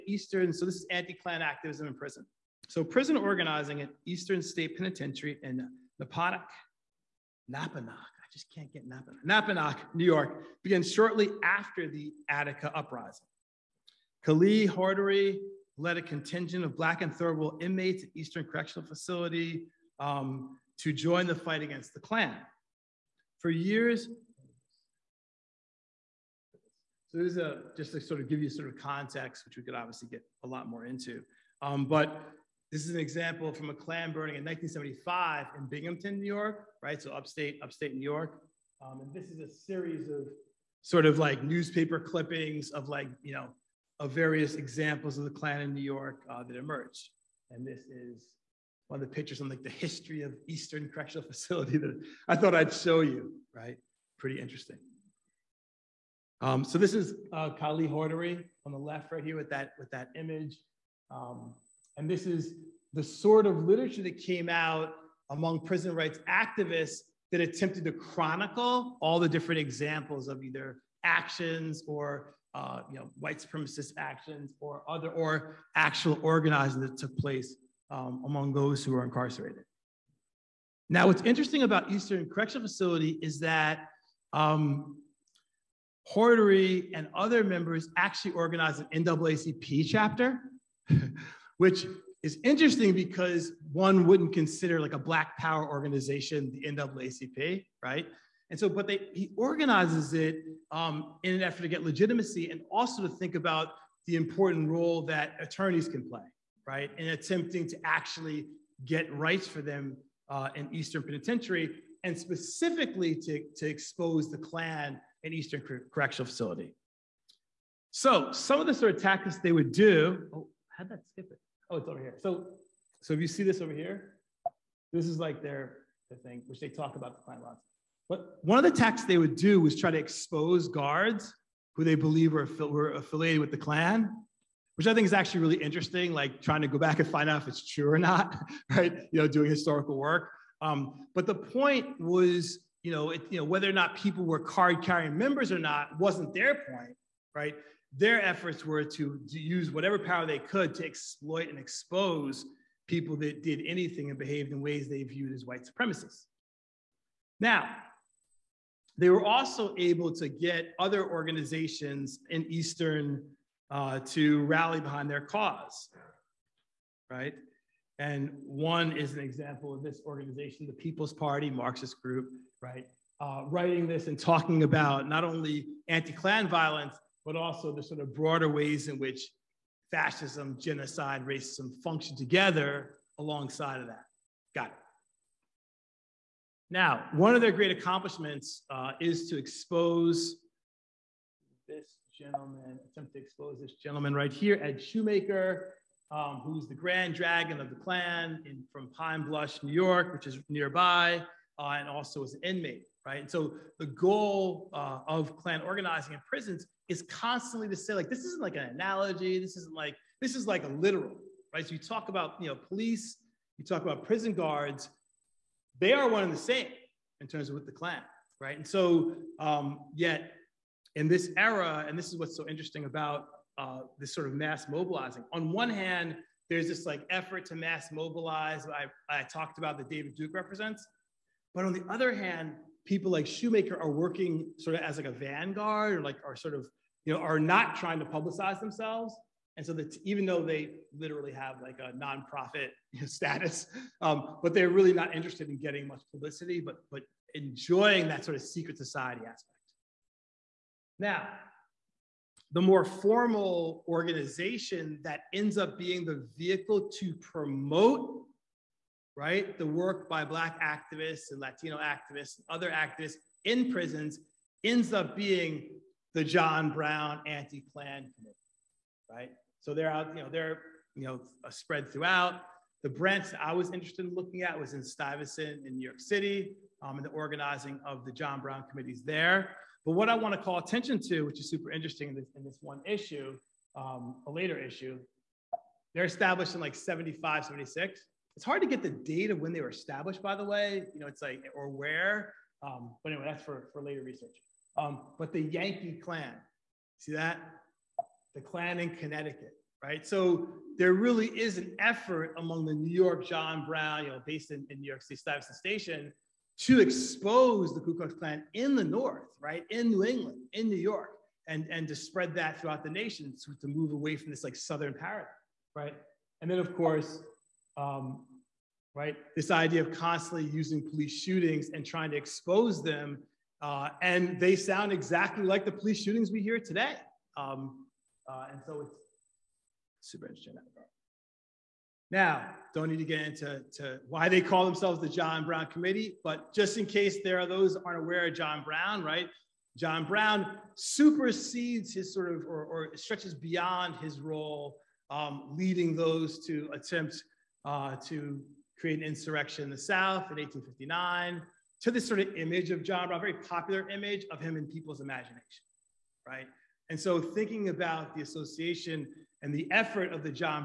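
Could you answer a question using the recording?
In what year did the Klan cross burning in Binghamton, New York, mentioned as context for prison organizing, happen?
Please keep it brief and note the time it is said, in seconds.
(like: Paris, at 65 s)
1975, at 34 s.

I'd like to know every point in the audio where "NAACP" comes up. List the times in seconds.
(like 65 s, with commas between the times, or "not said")
89 s, 96 s.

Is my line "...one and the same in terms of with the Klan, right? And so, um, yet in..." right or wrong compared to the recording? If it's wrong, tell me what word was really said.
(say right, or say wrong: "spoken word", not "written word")
right.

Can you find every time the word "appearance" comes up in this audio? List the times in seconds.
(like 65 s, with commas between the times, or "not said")
not said.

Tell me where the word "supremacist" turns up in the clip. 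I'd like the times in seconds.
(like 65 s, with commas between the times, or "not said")
73 s, 155 s.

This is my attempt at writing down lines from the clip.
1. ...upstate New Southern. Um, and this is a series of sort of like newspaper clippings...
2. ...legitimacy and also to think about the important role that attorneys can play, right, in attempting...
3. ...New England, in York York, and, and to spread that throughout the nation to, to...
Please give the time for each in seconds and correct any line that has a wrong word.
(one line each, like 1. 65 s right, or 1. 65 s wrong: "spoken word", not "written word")
1. 37 s wrong: "York", not "Southern"
2. 101 s right
3. 309 s wrong: "New", not "York".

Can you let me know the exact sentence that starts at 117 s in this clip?
So some of the sort of tactics they would do, oh, how'd that skip it?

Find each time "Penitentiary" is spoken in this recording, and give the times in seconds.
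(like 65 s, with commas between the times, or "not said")
4 s, 111 s.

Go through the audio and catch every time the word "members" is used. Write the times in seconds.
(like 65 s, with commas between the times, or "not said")
87 s, 145 s.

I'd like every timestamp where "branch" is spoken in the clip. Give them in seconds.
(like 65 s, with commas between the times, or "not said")
272 s.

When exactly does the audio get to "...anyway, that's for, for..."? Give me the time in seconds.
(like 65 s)
293 s.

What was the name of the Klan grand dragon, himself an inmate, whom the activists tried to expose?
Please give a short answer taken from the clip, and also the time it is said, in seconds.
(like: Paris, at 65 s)
Ed Shoemaker, at 194 s.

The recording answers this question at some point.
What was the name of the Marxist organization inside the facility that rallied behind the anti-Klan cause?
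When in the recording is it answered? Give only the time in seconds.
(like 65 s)
170 s.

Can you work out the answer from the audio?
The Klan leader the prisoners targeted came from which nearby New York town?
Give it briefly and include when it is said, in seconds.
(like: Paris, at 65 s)
Pine Bush, at 198 s.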